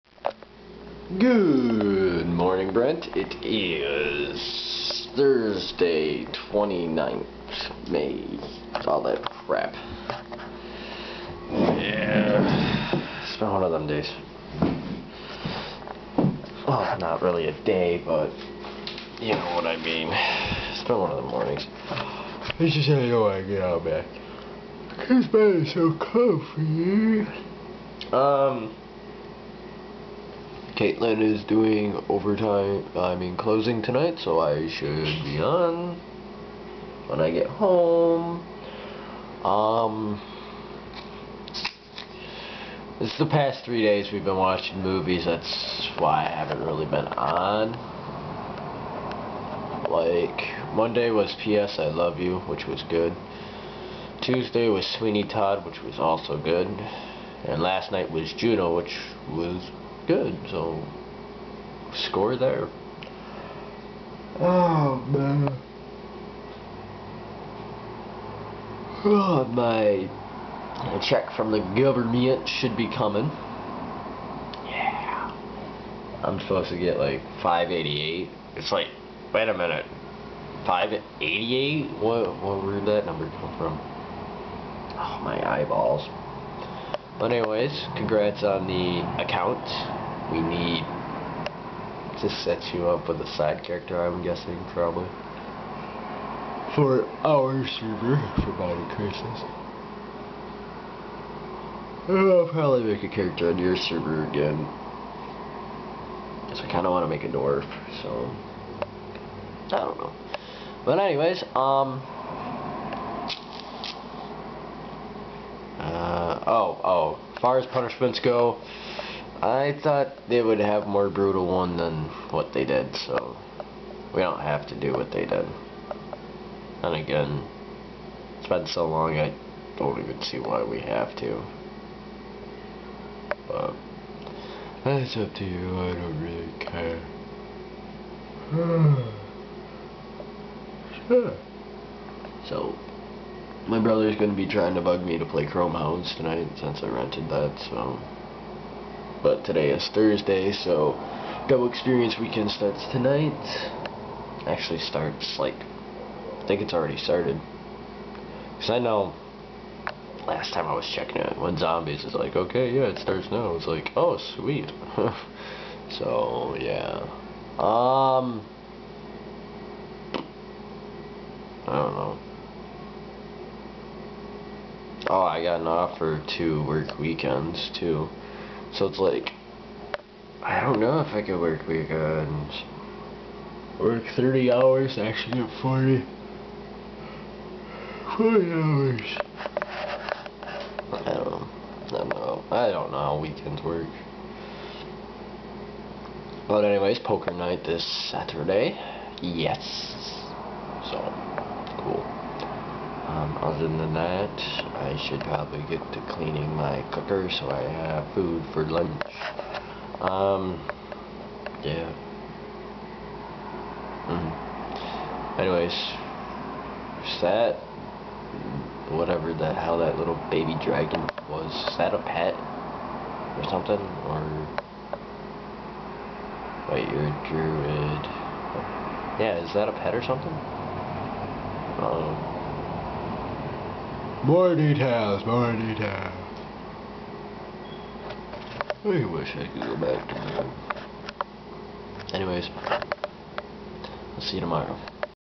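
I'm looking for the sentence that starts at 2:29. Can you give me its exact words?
But today is Thursday, so Double Experience Weekend starts tonight.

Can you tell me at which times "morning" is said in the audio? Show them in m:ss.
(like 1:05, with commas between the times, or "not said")
0:02, 0:21.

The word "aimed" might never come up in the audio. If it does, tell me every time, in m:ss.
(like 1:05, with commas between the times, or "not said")
not said.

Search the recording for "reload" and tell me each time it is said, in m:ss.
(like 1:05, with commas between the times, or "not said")
not said.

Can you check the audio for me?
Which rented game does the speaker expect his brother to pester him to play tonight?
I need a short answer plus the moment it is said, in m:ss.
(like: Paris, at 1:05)
Chromehounds, at 2:25.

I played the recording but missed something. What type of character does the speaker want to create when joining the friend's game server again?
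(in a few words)
dwarf.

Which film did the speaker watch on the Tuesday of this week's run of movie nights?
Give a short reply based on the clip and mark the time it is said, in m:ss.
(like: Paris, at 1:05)
Sweeney Todd, at 0:54.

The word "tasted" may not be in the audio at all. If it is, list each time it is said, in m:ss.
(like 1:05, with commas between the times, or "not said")
not said.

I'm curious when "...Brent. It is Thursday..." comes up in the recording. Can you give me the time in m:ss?
0:02.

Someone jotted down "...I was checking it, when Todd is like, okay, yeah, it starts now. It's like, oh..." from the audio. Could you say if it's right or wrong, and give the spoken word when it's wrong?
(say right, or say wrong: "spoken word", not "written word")
wrong: "Zombies", not "Todd".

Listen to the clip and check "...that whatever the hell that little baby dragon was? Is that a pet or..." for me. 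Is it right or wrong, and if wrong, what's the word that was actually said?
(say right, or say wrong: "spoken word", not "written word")
right.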